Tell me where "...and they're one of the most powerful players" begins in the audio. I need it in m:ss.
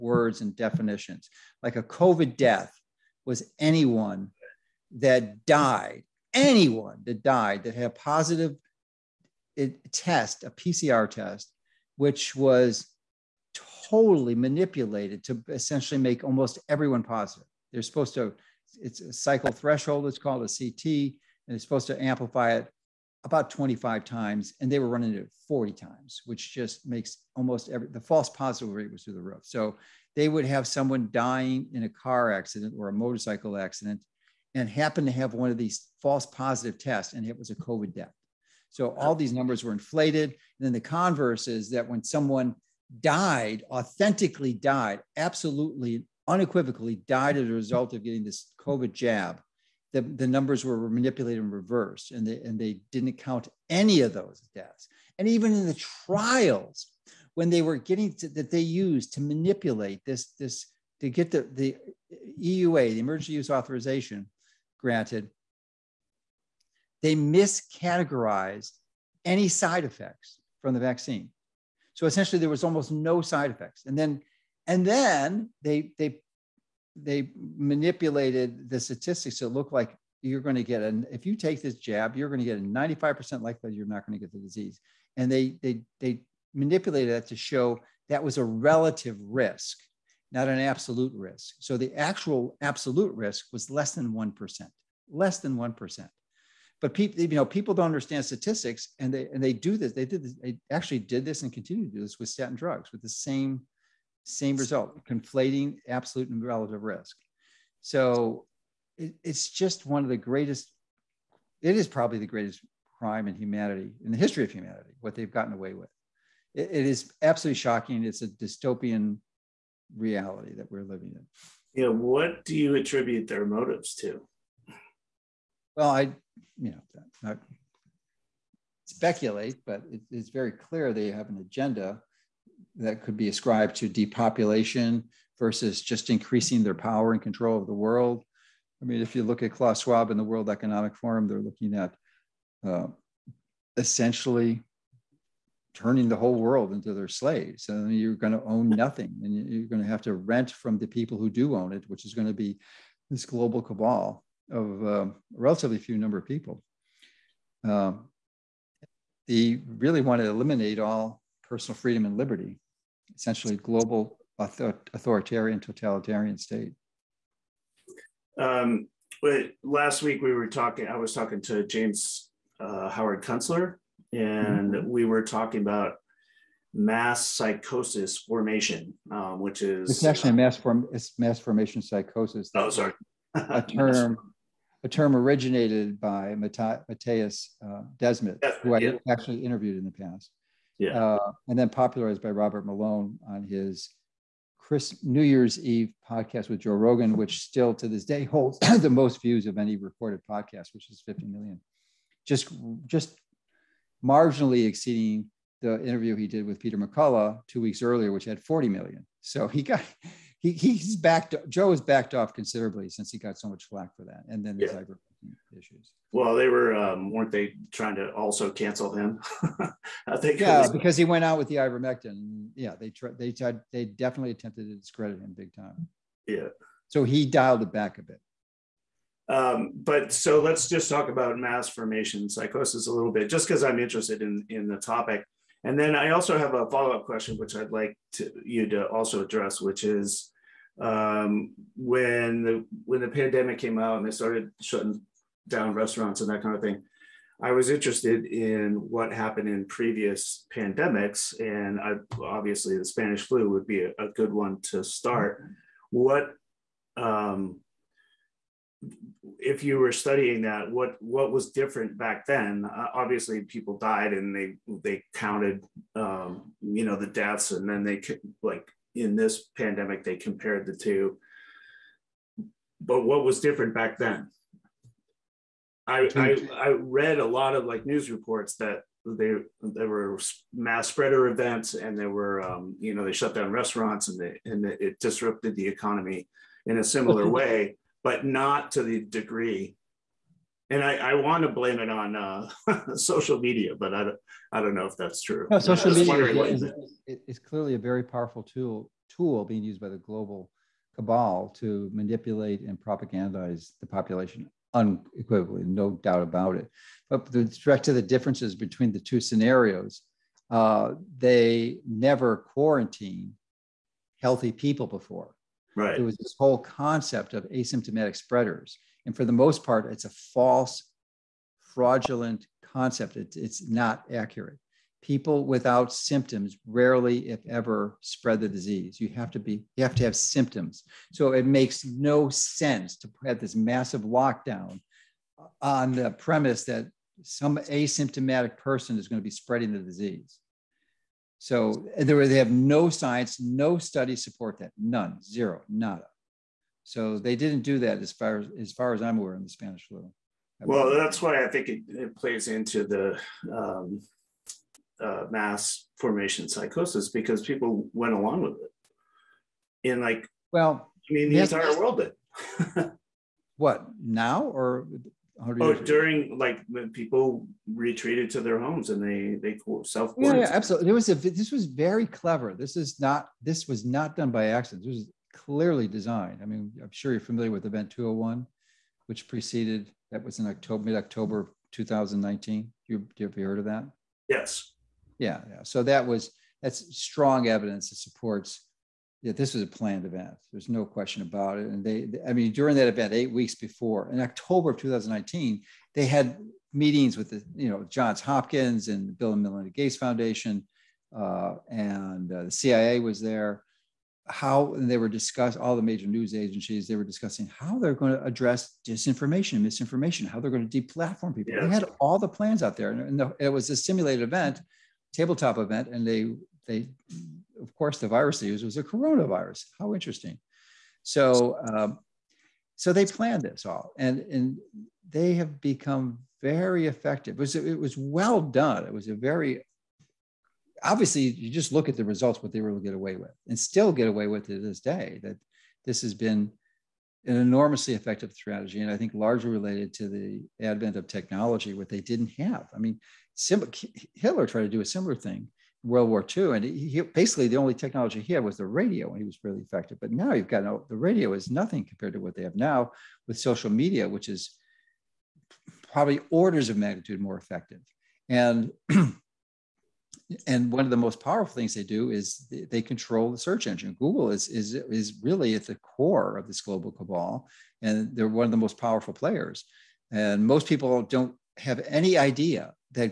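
7:47.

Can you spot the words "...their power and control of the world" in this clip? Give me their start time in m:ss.
2:16.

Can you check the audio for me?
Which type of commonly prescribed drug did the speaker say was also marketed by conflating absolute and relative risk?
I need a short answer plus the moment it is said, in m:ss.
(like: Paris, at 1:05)
statin drugs, at 1:42.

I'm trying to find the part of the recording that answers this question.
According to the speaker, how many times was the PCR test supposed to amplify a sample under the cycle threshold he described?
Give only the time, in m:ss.
0:23.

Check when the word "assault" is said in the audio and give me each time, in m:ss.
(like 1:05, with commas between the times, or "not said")
not said.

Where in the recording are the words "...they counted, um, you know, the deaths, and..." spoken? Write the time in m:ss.
4:24.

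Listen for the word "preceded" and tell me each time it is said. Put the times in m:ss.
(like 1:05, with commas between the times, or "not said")
6:19.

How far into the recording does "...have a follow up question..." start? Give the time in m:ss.
3:56.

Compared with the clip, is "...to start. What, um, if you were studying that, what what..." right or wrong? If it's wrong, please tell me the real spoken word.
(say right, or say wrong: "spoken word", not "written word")
right.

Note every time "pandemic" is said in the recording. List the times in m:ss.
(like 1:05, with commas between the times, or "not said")
4:03, 4:10, 4:29.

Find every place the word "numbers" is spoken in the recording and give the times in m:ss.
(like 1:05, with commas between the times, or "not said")
0:39, 0:50, 2:35.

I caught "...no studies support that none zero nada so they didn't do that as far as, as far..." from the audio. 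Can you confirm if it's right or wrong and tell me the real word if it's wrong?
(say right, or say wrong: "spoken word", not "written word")
right.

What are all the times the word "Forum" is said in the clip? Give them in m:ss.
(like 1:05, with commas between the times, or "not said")
2:20.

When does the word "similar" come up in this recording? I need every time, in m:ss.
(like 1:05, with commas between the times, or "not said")
4:46, 7:24.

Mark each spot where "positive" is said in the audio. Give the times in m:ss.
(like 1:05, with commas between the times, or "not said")
0:07, 0:17, 0:28, 0:36.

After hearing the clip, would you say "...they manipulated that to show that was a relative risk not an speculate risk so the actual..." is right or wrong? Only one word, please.
wrong.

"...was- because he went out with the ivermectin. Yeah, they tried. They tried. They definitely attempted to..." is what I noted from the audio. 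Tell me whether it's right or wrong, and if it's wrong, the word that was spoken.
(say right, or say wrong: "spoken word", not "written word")
right.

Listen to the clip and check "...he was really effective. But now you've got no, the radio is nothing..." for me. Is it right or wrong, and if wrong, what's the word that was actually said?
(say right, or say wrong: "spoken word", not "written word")
right.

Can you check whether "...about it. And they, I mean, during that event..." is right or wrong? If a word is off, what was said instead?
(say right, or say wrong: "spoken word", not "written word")
right.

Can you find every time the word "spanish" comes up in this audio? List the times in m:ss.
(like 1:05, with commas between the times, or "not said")
4:12, 5:49.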